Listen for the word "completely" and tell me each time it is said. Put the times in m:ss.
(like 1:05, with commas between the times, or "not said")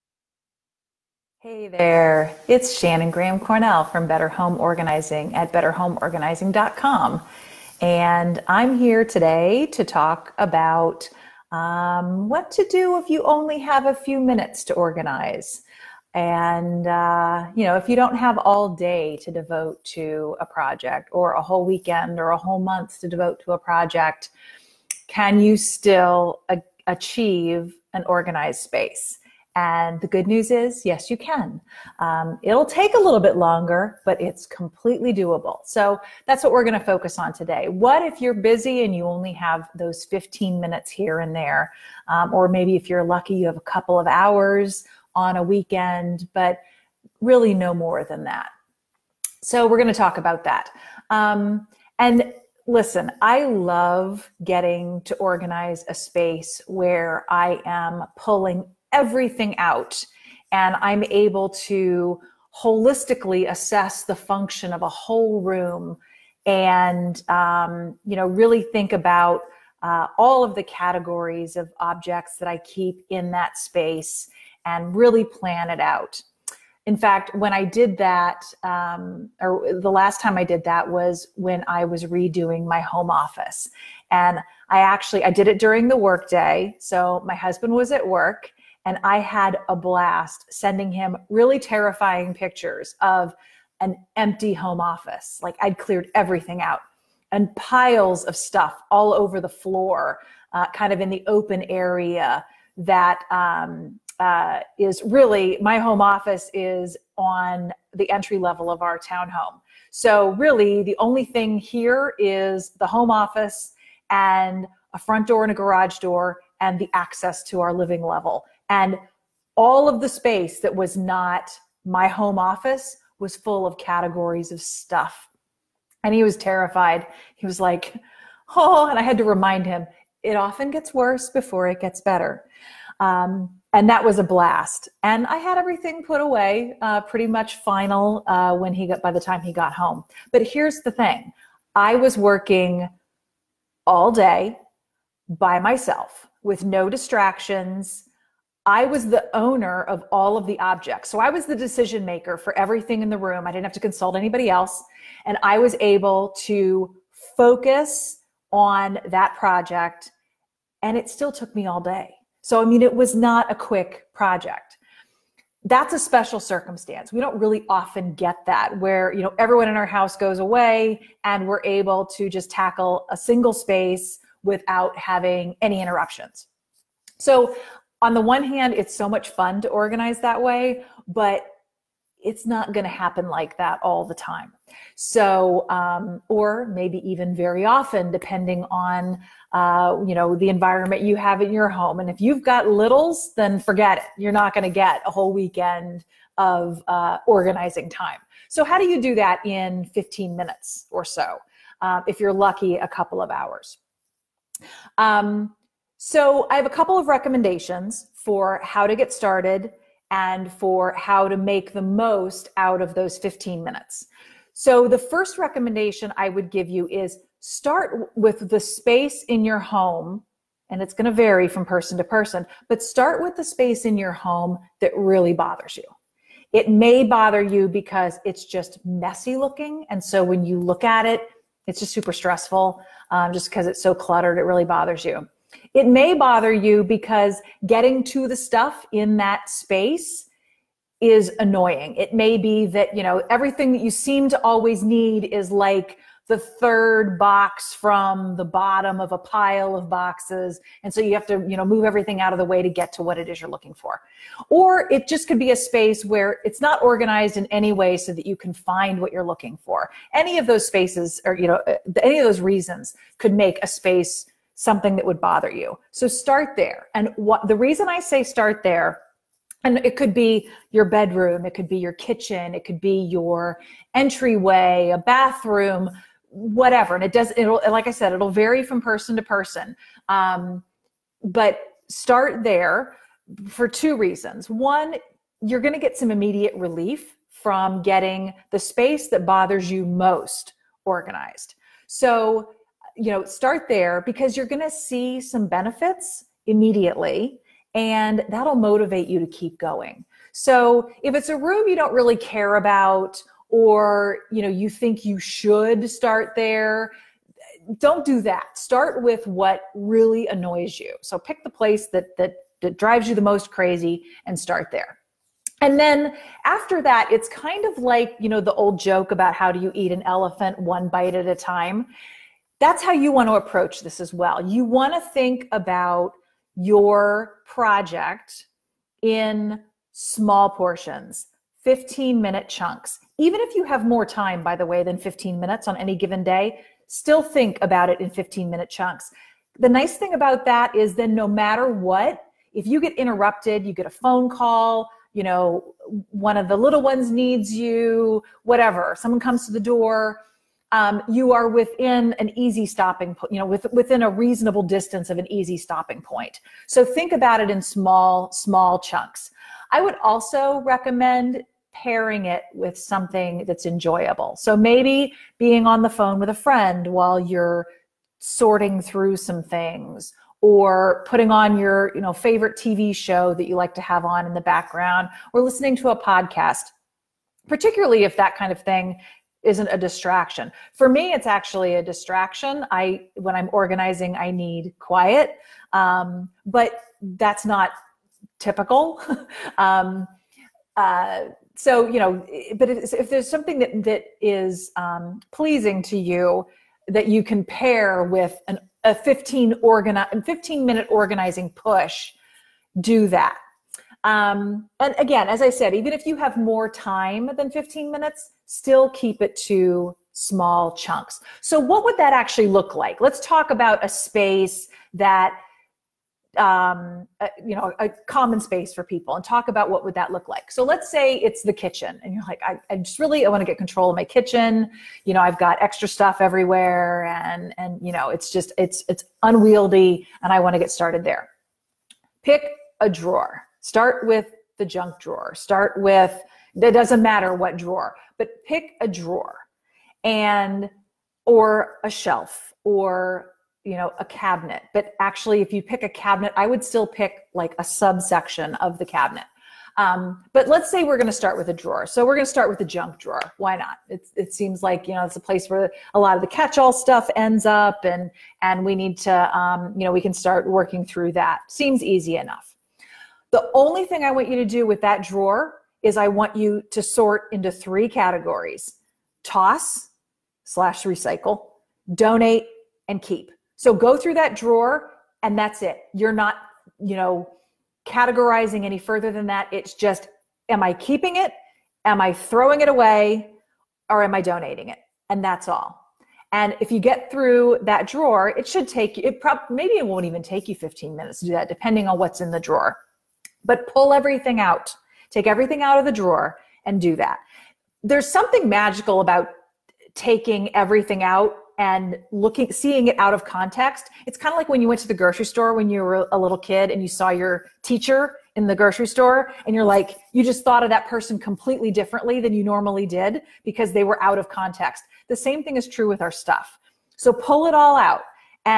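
0:34, 8:31.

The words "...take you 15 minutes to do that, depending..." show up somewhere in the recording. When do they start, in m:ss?
8:10.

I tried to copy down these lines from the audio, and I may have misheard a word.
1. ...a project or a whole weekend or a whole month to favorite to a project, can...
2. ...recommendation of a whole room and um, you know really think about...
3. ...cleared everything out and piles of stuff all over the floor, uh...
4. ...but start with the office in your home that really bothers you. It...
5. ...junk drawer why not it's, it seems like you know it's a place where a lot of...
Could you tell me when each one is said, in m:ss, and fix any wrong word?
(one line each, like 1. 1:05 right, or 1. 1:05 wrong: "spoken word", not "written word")
1. 0:20 wrong: "devote", not "favorite"
2. 1:04 wrong: "function", not "recommendation"
3. 1:35 right
4. 3:42 wrong: "space", not "office"
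5. 7:32 right.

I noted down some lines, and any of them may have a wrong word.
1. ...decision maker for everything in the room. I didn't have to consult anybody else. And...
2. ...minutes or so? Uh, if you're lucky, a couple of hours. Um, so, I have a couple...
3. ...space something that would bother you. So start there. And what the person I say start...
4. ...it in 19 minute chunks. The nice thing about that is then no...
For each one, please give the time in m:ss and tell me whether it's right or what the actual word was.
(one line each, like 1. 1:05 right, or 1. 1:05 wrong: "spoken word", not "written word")
1. 2:31 right
2. 3:20 right
3. 4:23 wrong: "reason", not "person"
4. 5:37 wrong: "15", not "19".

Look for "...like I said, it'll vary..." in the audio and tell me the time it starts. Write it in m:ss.
4:37.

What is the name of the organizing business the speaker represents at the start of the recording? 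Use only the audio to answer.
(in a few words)
Better Home Organizing.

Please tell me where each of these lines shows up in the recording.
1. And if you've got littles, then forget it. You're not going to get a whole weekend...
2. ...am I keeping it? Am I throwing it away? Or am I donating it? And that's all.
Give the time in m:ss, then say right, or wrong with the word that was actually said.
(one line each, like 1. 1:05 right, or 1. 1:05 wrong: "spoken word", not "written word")
1. 3:11 right
2. 8:00 right.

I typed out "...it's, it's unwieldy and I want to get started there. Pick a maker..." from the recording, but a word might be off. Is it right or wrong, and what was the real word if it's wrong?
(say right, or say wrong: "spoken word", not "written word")
wrong: "drawer", not "maker".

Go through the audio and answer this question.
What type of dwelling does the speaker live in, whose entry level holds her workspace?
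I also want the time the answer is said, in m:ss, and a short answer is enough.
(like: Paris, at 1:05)
townhome, at 1:48.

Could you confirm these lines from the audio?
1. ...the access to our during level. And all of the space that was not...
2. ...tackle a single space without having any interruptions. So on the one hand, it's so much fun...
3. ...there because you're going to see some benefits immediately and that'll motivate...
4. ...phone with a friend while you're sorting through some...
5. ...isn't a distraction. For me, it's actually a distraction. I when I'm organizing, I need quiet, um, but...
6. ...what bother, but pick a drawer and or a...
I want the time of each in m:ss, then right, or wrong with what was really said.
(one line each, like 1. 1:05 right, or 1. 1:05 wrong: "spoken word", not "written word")
1. 1:56 wrong: "living", not "during"
2. 2:52 right
3. 4:53 right
4. 6:05 right
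5. 6:19 right
6. 7:17 wrong: "drawer", not "bother".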